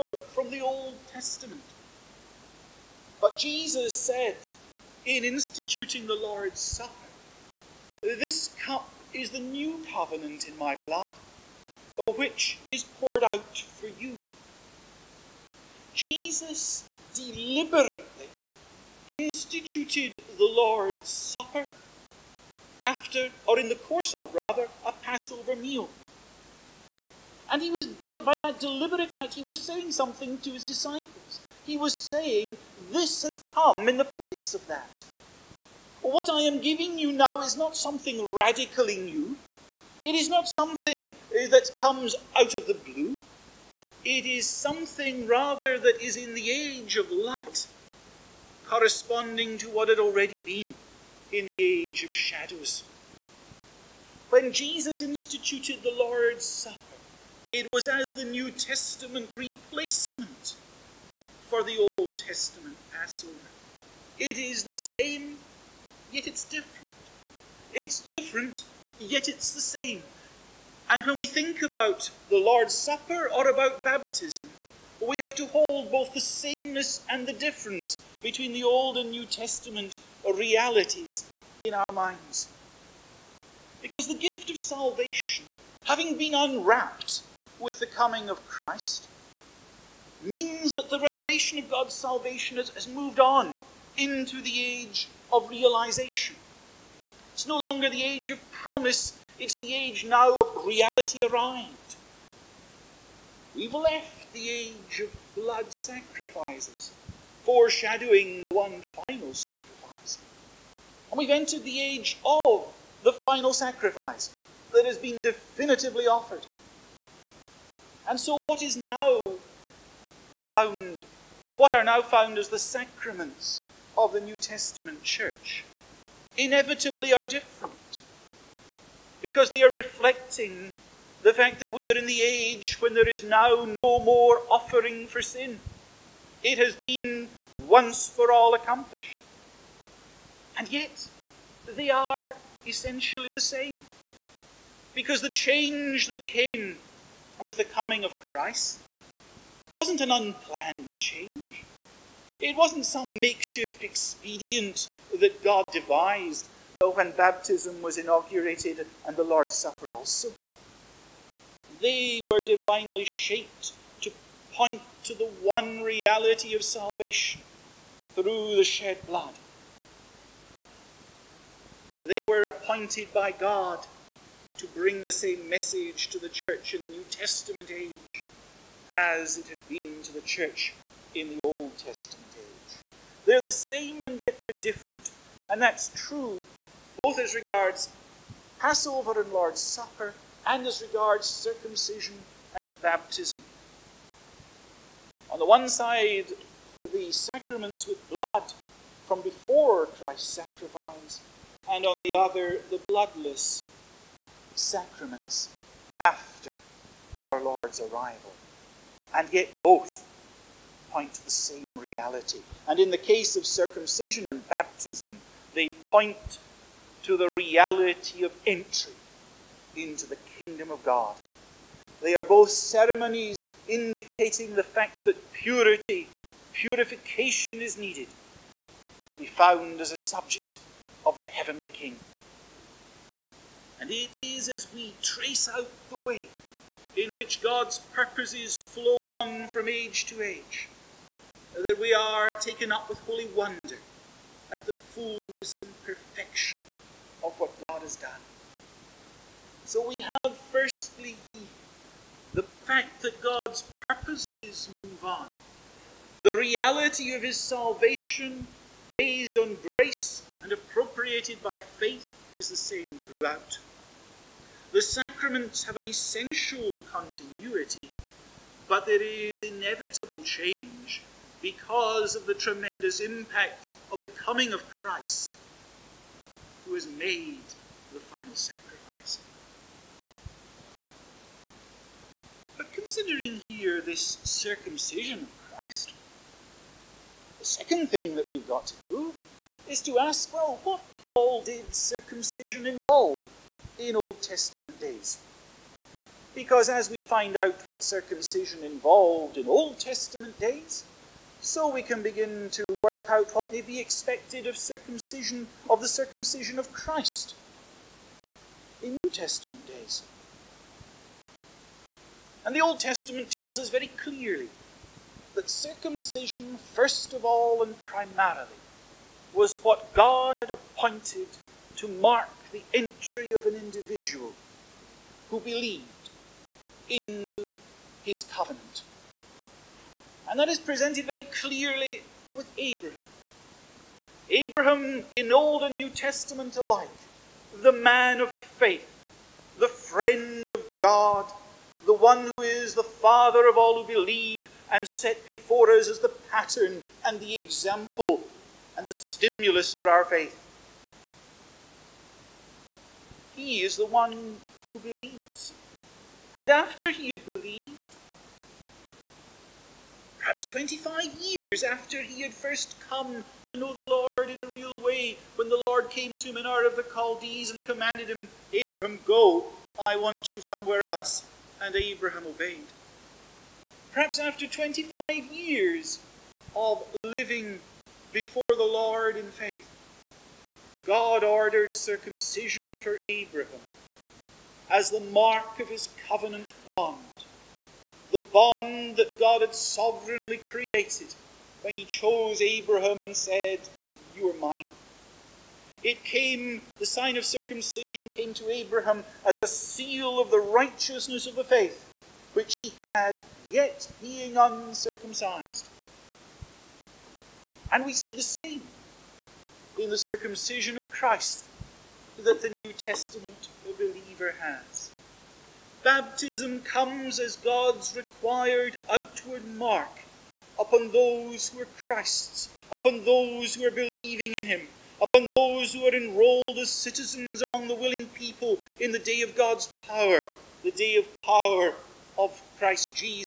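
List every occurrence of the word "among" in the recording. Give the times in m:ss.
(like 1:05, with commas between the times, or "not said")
7:07.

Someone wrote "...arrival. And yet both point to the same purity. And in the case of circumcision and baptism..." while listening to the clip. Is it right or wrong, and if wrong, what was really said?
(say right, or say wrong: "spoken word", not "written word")
wrong: "reality", not "purity".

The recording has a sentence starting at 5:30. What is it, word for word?
And that is presented very clearly with Abraham.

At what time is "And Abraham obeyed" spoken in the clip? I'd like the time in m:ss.
6:11.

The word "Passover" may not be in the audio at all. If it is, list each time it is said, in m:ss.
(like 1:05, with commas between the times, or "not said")
0:24, 1:02, 3:08.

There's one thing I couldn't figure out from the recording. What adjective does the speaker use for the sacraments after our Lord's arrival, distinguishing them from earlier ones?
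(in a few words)
bloodless.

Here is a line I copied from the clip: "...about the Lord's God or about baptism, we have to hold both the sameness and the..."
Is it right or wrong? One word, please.
wrong.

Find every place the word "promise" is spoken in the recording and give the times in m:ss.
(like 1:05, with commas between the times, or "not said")
1:38.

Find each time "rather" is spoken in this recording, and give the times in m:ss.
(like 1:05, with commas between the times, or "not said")
0:24, 0:45.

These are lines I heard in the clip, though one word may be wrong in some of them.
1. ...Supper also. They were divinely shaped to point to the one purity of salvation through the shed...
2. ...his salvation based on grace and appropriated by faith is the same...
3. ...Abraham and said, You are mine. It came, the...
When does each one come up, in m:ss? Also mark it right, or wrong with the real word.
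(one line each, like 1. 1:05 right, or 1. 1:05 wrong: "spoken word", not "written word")
1. 2:39 wrong: "reality", not "purity"
2. 4:17 right
3. 6:32 right.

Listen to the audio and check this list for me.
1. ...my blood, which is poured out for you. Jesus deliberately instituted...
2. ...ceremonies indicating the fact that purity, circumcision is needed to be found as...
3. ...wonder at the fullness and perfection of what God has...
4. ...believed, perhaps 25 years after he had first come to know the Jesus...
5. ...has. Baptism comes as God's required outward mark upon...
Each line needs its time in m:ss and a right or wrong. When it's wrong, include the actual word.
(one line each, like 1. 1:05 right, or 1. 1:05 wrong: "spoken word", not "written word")
1. 0:10 right
2. 3:42 wrong: "purification", not "circumcision"
3. 4:03 right
4. 5:57 wrong: "Lord", not "Jesus"
5. 6:54 right.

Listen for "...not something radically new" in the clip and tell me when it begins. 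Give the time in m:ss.
0:37.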